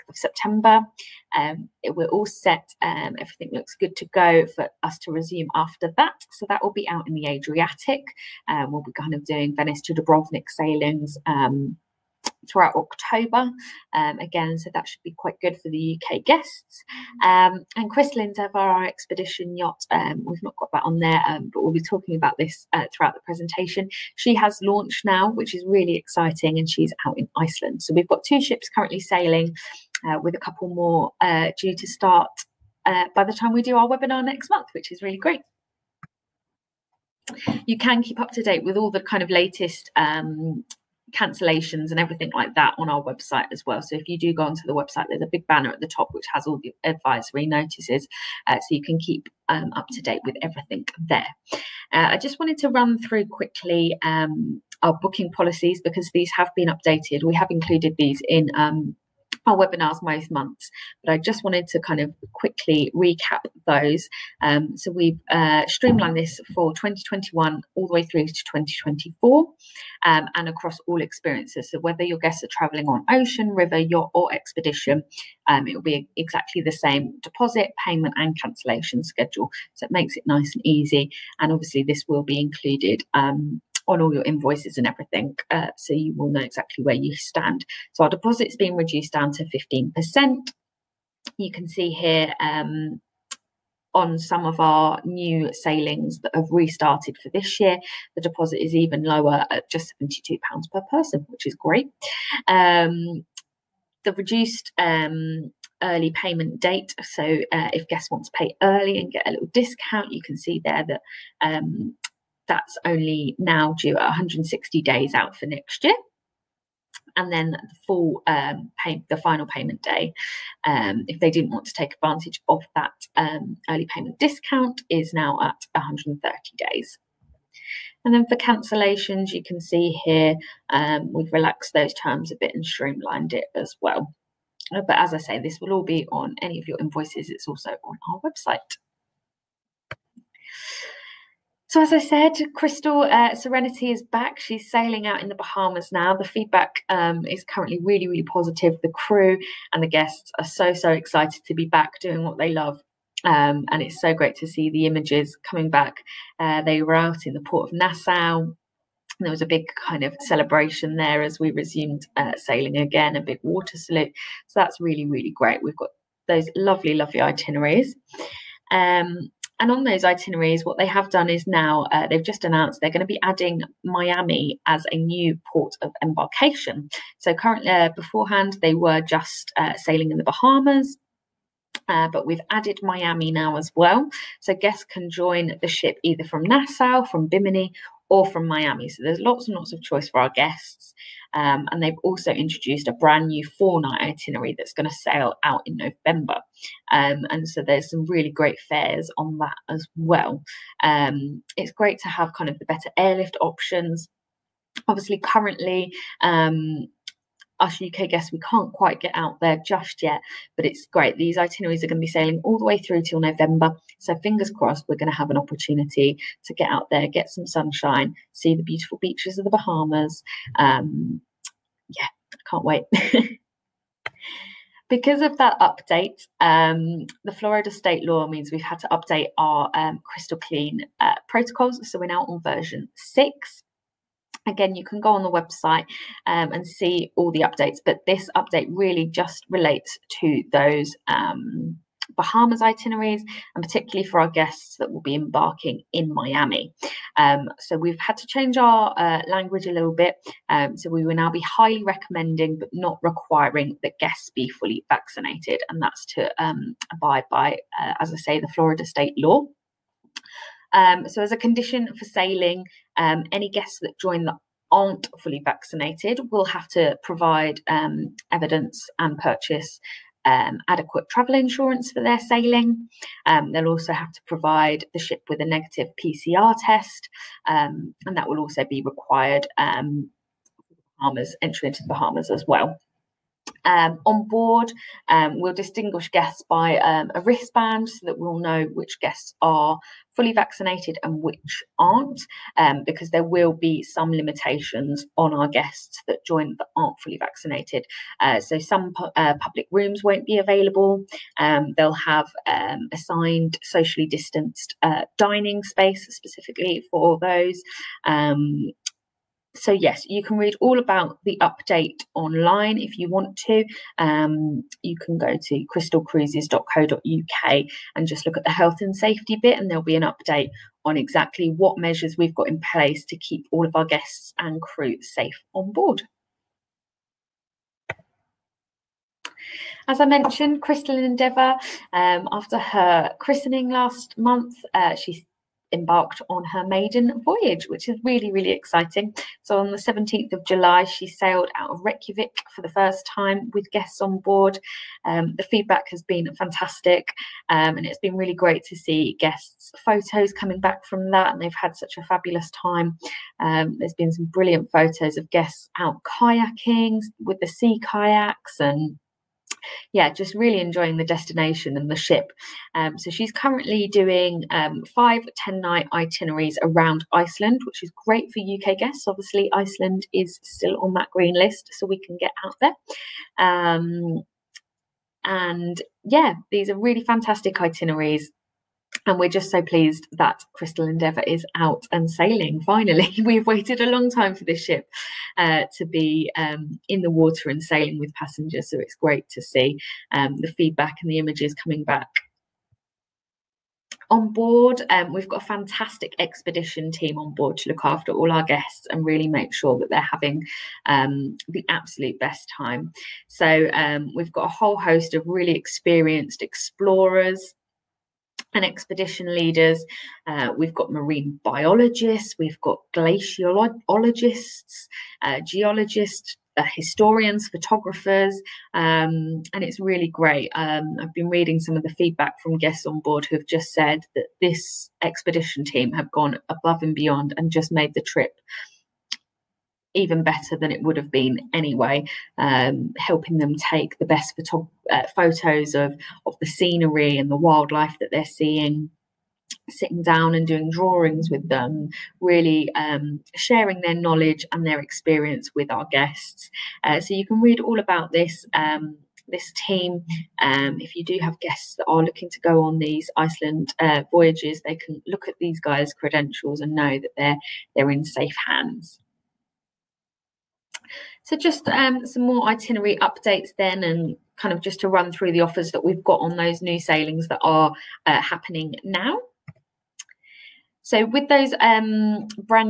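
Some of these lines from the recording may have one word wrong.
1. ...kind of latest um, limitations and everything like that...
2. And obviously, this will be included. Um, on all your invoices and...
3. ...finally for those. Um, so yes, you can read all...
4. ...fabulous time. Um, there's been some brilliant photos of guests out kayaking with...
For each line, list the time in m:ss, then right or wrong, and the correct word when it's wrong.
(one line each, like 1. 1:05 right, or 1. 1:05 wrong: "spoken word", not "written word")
1. 0:38 wrong: "cancellations", not "limitations"
2. 1:21 right
3. 5:06 wrong: "specifically", not "finally"
4. 5:52 right.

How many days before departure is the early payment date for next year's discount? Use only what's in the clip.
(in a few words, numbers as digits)
160 days.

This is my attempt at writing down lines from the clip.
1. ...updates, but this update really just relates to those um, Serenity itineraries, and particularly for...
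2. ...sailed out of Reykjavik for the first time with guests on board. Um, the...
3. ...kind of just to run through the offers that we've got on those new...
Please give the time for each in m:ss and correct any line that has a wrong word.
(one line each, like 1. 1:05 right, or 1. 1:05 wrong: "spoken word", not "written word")
1. 3:57 wrong: "Bahamas", not "Serenity"
2. 5:41 right
3. 7:44 right.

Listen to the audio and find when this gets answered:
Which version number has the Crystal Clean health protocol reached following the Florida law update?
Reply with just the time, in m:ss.
3:52.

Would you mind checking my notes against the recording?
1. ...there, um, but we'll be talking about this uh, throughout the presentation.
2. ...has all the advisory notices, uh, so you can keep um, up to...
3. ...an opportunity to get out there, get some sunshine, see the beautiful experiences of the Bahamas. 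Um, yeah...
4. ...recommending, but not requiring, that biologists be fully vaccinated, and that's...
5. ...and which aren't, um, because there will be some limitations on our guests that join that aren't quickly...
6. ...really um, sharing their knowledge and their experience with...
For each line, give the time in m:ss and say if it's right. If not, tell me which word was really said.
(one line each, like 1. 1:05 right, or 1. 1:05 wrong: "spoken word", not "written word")
1. 0:20 right
2. 0:46 right
3. 3:35 wrong: "beaches", not "experiences"
4. 4:11 wrong: "guests", not "biologists"
5. 4:51 wrong: "fully", not "quickly"
6. 7:22 right.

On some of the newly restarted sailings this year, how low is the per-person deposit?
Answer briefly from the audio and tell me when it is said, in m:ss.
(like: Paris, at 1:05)
£72, at 1:40.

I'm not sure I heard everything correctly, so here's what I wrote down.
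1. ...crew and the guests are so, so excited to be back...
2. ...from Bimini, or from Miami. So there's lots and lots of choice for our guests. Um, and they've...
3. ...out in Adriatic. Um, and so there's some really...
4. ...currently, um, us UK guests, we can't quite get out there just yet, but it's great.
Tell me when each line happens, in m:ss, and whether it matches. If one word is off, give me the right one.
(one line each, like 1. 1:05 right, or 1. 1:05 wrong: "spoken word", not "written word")
1. 2:28 right
2. 3:07 right
3. 3:15 wrong: "November", not "Adriatic"
4. 3:25 right.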